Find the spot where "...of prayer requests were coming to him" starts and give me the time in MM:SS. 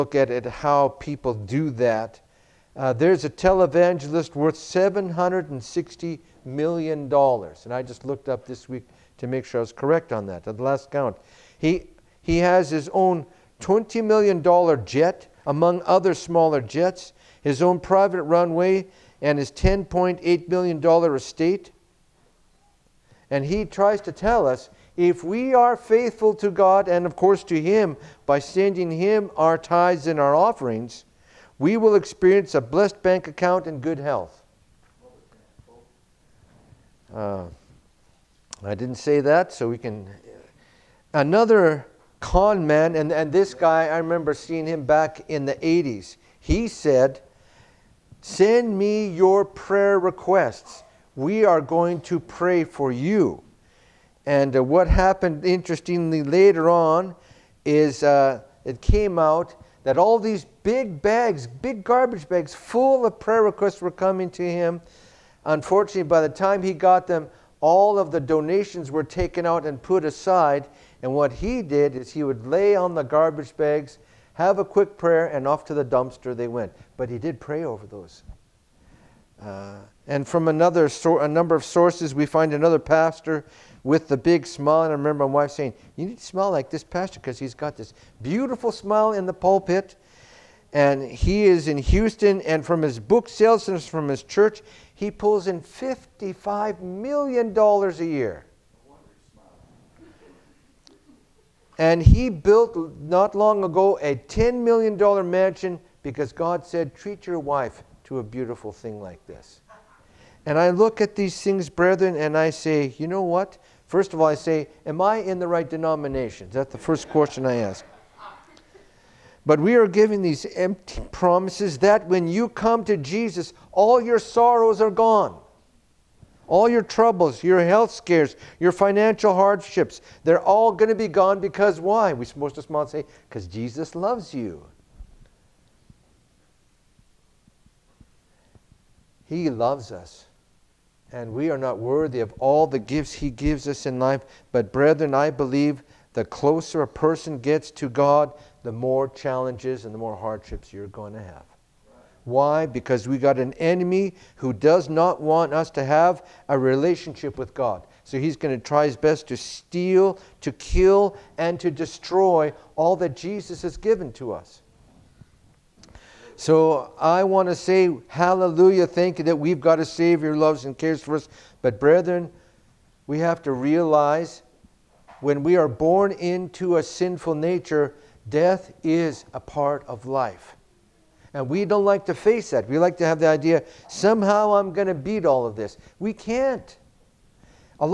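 01:03.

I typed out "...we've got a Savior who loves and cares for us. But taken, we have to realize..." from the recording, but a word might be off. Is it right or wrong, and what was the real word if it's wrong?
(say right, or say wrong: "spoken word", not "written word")
wrong: "brethren", not "taken".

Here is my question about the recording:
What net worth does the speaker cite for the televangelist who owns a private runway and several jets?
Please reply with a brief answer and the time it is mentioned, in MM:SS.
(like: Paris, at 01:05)
$760 million, at 00:04.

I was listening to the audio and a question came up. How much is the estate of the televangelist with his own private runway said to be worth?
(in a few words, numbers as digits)
$10.8 million.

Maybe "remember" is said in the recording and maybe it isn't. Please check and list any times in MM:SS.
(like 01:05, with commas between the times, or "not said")
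00:43, 01:24.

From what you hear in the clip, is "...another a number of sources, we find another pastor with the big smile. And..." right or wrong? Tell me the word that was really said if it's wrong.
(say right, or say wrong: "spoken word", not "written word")
right.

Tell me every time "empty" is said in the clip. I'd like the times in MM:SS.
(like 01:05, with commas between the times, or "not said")
02:00.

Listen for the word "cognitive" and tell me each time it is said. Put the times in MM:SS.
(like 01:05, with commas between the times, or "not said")
not said.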